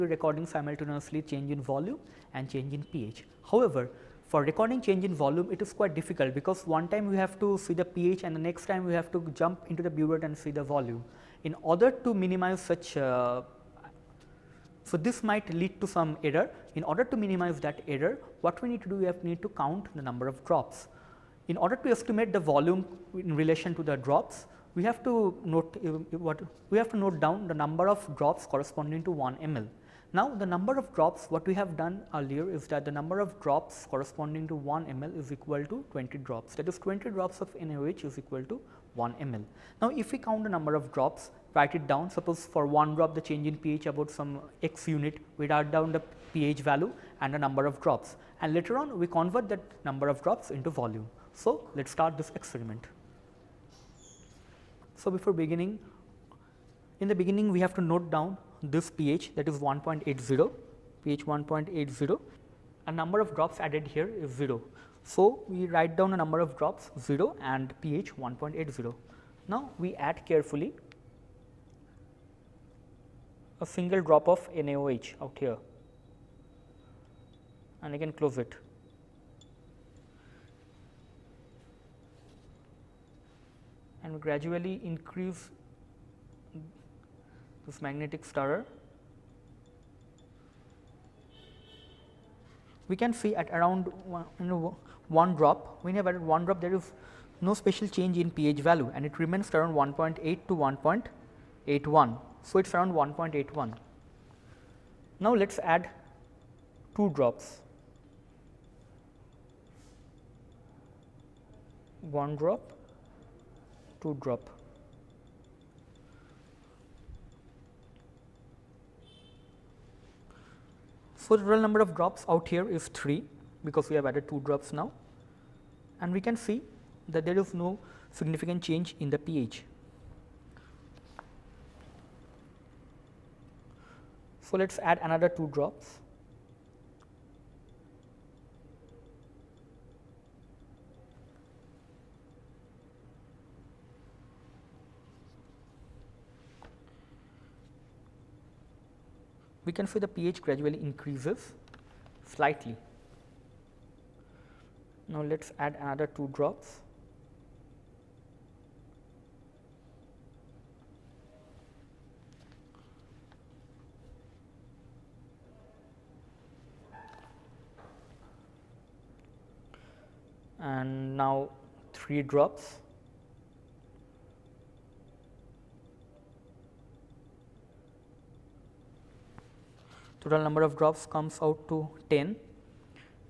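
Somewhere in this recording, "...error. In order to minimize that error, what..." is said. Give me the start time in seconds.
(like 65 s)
16 s.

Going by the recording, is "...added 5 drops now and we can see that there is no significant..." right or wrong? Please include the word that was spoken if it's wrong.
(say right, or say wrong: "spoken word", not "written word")
wrong: "2", not "5".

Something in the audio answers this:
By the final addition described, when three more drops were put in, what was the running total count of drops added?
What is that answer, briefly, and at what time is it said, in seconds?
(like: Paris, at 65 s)
10, at 182 s.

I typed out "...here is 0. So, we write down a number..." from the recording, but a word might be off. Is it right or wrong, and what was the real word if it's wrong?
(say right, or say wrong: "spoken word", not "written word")
right.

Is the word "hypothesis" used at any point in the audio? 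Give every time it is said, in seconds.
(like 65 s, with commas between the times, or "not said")
not said.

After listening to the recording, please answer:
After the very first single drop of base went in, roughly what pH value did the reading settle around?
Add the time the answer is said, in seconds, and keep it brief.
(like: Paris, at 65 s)
1.81, at 102 s.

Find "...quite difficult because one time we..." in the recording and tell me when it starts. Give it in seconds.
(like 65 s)
5 s.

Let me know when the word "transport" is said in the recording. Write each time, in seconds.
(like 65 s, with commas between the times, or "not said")
not said.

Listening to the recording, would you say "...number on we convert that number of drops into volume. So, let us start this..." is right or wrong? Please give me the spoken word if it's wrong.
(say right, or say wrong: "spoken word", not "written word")
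wrong: "later", not "number".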